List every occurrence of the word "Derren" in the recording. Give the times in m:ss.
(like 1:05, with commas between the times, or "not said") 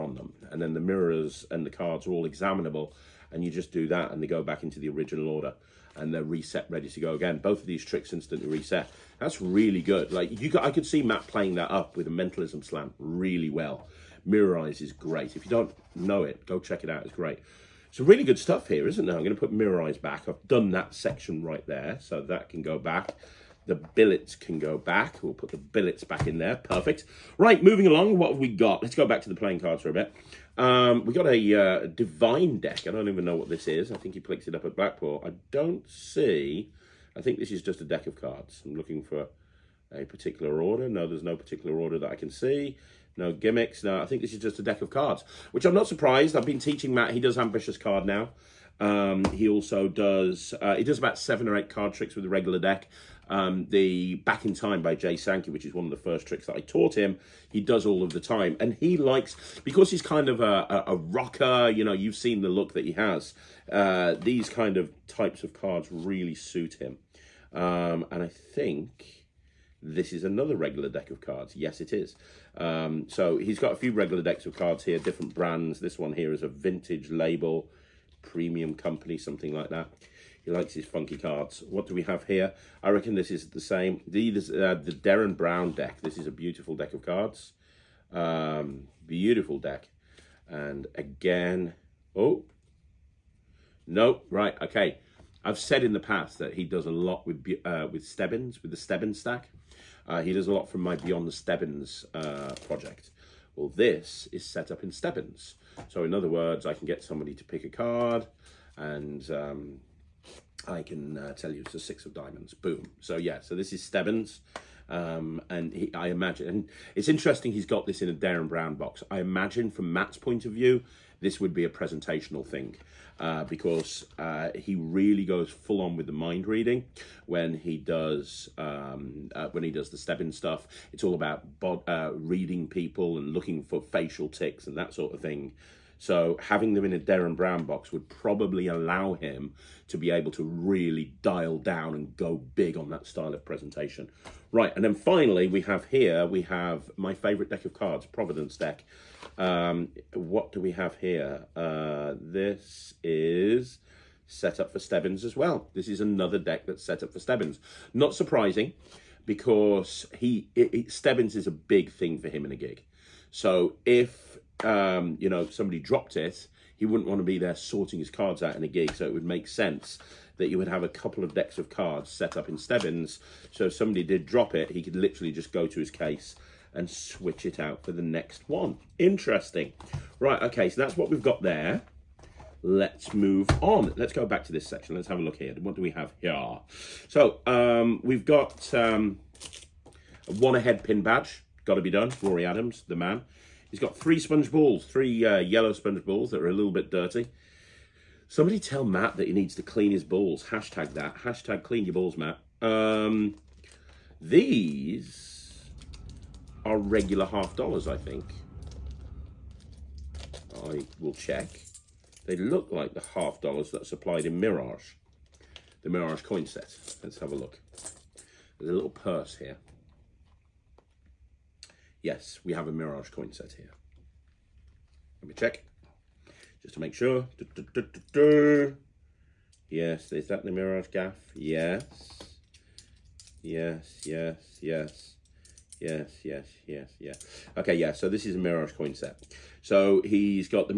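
1:24, 1:58, 2:16.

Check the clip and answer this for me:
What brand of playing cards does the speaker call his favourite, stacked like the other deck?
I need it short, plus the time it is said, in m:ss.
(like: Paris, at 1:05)
Providence, at 2:28.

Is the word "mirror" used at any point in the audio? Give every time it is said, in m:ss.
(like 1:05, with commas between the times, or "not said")
0:00, 0:14, 0:19.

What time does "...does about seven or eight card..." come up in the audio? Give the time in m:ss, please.
0:50.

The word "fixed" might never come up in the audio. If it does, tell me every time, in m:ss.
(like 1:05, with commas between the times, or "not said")
not said.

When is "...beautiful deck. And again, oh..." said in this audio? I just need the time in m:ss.
1:29.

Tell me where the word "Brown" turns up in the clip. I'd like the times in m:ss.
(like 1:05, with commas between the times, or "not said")
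1:25, 1:58, 2:17.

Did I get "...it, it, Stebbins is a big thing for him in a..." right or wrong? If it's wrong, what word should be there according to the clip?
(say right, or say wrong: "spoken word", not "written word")
right.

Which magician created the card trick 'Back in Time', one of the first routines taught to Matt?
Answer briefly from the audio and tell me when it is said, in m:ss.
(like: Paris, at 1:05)
Jay Sankey, at 0:54.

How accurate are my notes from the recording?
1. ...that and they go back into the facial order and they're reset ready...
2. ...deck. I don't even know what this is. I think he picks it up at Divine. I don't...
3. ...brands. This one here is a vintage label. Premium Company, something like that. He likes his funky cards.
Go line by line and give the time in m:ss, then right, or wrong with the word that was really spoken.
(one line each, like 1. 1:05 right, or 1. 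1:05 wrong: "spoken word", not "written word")
1. 0:03 wrong: "original", not "facial"
2. 0:32 wrong: "Blackpool", not "Divine"
3. 1:15 right.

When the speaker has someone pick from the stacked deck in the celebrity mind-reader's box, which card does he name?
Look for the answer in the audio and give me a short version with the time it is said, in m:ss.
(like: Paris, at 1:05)
Six of diamonds, at 1:51.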